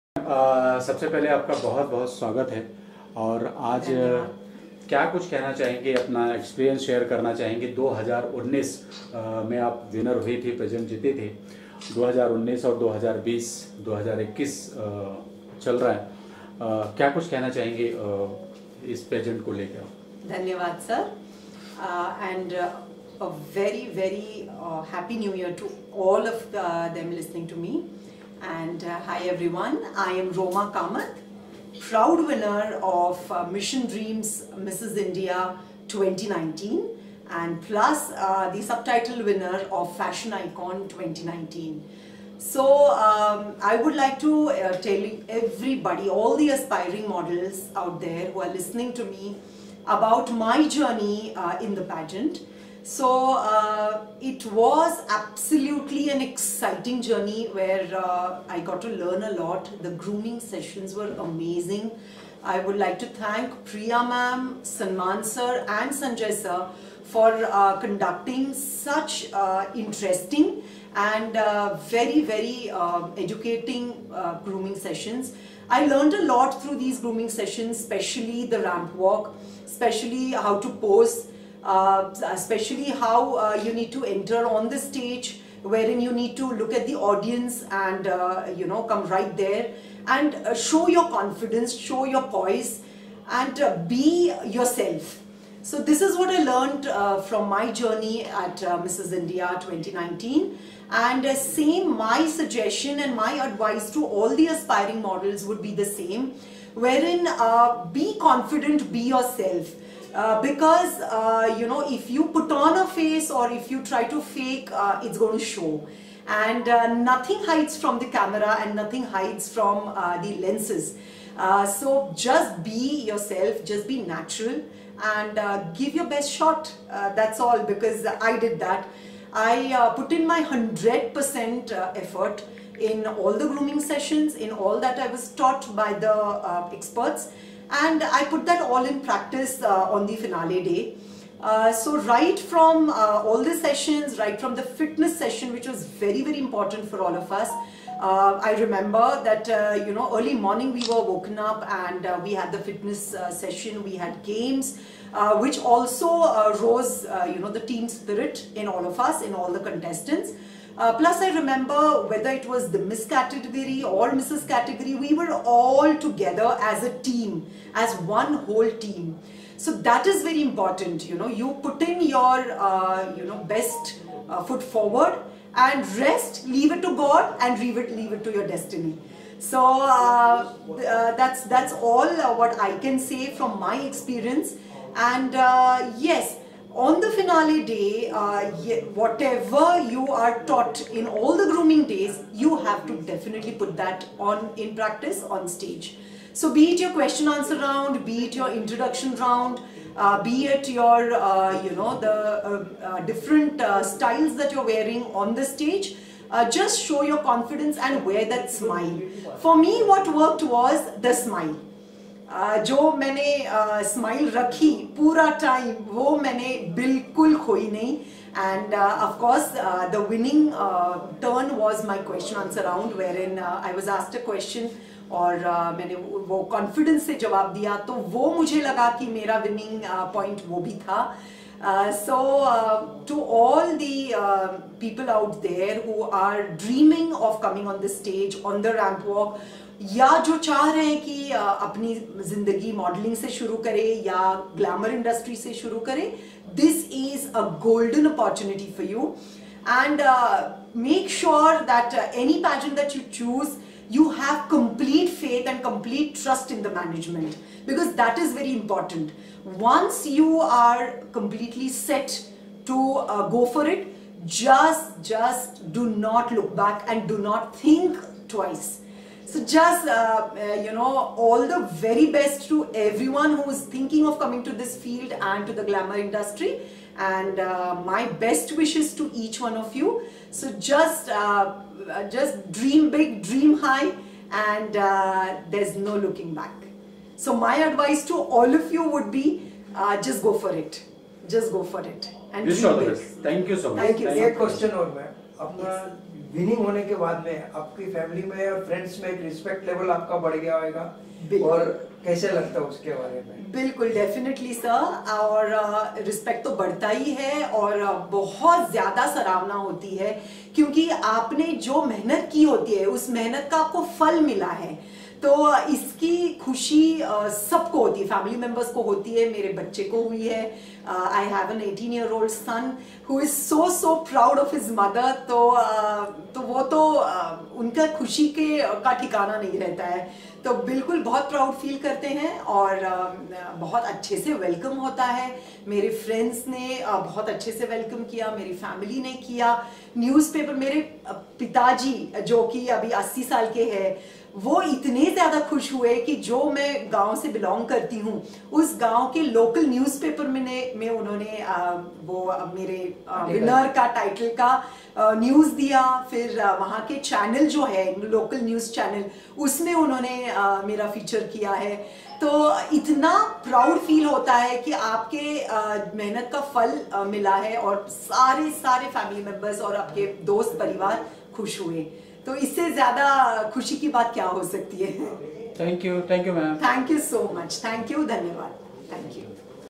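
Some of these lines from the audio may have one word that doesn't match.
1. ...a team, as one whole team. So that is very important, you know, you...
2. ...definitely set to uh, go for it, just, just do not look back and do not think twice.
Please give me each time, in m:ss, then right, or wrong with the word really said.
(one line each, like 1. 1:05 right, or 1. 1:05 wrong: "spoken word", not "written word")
1. 2:46 right
2. 4:21 wrong: "completely", not "definitely".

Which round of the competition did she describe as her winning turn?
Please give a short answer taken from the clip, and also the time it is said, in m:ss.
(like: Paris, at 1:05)
Question answer round, at 3:42.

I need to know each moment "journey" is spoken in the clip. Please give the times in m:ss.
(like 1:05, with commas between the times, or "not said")
0:50, 0:57, 1:37.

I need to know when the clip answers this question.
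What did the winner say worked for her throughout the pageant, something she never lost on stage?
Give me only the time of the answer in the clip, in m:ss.
3:31.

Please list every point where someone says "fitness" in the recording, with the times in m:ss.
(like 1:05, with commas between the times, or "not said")
2:24, 2:32.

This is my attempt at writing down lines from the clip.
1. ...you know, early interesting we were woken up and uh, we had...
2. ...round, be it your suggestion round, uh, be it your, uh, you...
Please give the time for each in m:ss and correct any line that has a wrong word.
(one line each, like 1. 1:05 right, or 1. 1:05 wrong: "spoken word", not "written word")
1. 2:29 wrong: "morning", not "interesting"
2. 3:17 wrong: "introduction", not "suggestion".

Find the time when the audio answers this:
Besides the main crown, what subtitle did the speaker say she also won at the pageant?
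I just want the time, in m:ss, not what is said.
0:39.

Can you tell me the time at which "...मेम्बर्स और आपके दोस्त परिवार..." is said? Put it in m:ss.
6:09.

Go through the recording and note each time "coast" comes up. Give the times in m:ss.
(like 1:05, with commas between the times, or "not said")
not said.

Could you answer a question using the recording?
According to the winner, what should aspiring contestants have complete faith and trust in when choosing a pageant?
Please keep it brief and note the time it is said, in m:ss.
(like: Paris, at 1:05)
The management, at 4:16.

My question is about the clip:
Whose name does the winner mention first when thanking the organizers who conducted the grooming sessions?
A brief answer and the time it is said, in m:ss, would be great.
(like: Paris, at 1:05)
Priya, at 1:03.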